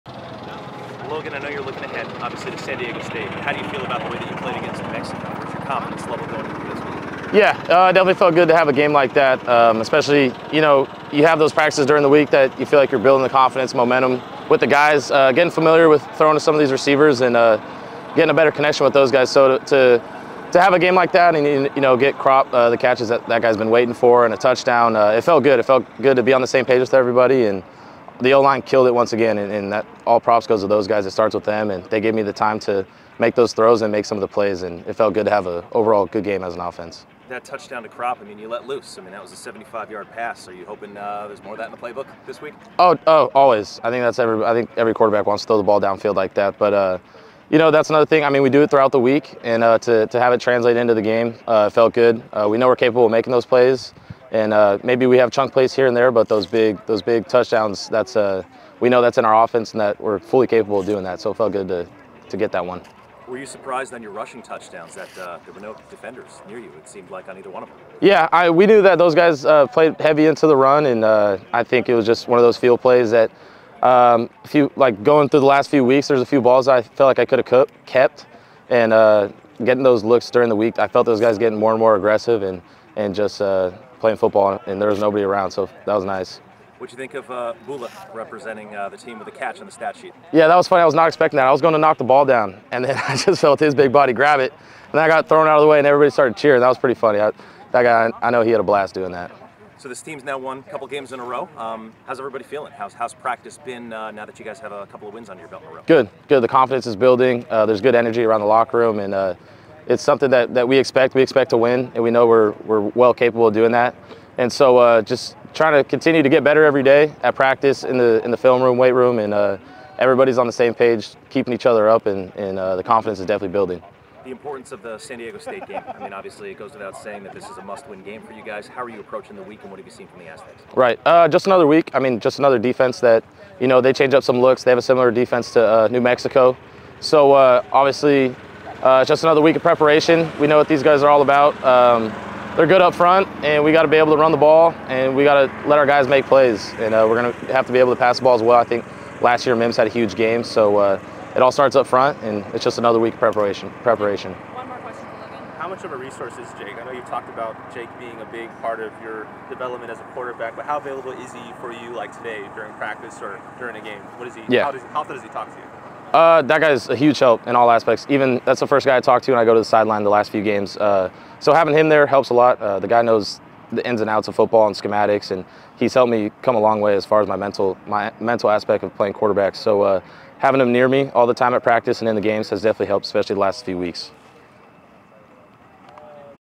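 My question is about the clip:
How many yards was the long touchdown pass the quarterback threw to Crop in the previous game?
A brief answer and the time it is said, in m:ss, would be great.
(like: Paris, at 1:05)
75, at 0:39.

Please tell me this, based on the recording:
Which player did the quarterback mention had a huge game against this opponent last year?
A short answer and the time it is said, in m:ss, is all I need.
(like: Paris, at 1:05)
Mims, at 2:29.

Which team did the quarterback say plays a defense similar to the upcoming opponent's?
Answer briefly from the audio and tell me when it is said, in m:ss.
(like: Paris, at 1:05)
New Mexico, at 2:15.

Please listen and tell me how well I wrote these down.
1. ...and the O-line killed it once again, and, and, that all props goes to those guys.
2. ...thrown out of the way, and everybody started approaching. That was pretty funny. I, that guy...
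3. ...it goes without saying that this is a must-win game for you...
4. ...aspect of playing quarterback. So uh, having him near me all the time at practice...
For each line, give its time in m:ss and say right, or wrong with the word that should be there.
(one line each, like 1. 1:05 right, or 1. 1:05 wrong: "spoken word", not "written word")
1. 0:27 right
2. 1:35 wrong: "cheering", not "approaching"
3. 2:06 right
4. 2:58 right.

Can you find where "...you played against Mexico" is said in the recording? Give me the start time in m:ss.
0:04.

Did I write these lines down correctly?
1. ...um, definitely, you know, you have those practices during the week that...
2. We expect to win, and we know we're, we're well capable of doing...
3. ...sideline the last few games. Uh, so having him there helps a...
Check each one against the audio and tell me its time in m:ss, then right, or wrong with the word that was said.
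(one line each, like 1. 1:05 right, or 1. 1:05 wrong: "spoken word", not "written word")
1. 0:09 wrong: "especially", not "definitely"
2. 1:51 right
3. 2:49 right.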